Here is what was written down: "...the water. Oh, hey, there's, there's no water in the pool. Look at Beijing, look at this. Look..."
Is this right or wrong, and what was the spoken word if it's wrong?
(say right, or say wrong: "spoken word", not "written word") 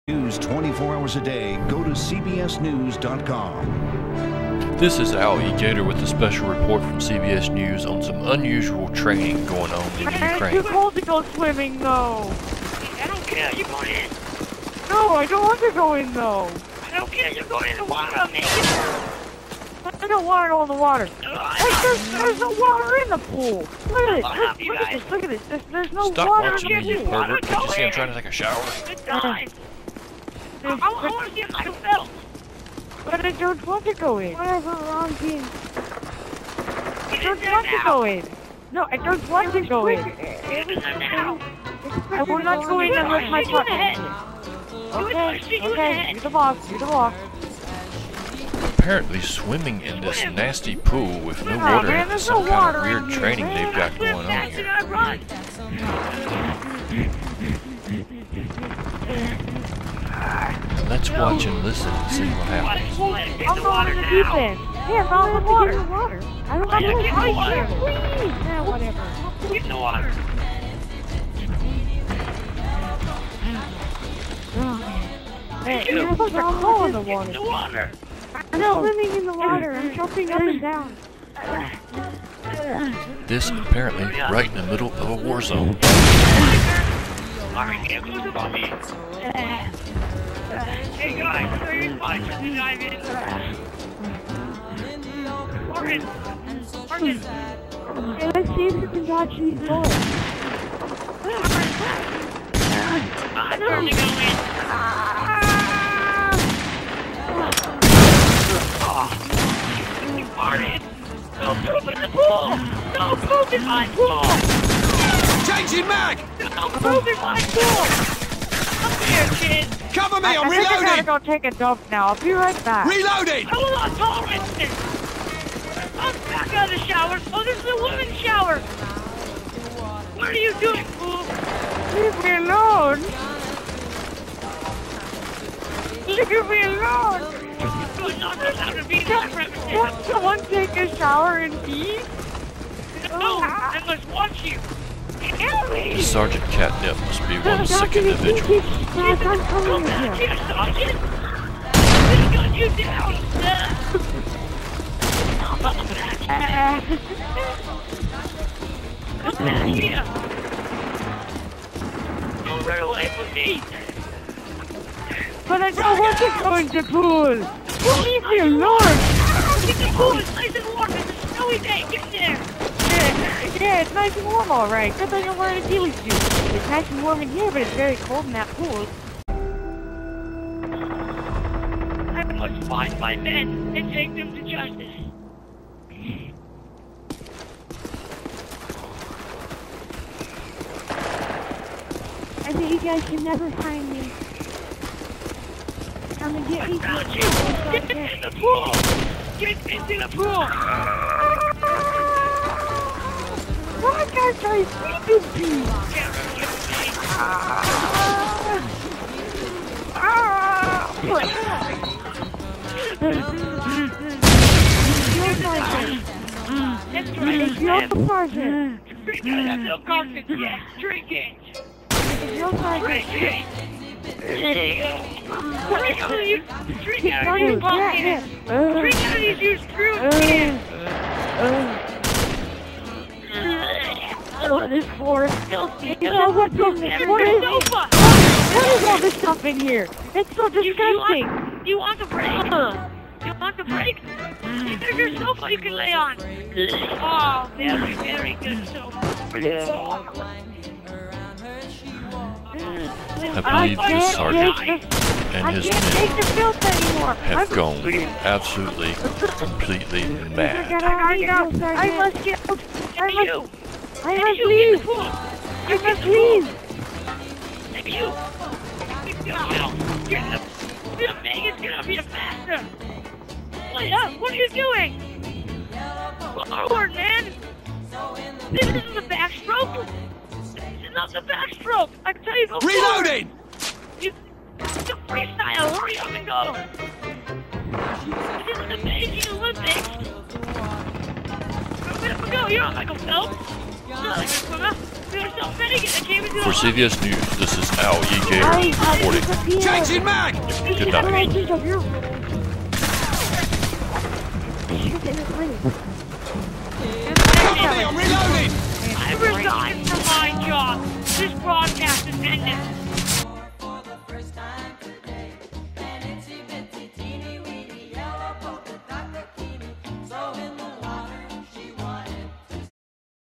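wrong: "Look", not "Beijing".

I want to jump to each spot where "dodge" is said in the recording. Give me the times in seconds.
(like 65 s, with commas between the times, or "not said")
99 s.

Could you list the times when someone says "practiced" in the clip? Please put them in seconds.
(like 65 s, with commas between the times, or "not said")
not said.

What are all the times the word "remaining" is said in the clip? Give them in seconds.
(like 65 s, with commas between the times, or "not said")
not said.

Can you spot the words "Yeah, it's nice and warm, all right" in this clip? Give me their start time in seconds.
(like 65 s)
173 s.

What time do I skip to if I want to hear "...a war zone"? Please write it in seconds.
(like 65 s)
85 s.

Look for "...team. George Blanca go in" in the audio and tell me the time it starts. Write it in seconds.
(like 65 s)
35 s.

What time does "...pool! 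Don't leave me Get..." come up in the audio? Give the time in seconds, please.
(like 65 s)
166 s.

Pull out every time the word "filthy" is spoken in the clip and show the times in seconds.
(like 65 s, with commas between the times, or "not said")
235 s.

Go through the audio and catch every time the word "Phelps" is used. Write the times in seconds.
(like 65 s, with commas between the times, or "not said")
292 s.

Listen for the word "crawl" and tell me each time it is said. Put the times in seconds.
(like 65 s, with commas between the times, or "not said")
76 s.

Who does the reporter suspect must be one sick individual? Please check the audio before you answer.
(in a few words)
Sergeant Catnip.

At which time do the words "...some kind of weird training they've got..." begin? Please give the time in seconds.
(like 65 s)
52 s.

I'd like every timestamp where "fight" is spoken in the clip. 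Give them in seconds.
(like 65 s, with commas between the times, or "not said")
91 s.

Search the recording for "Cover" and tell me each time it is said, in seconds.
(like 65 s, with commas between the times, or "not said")
119 s, 307 s.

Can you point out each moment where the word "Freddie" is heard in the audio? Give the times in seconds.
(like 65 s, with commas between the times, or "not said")
not said.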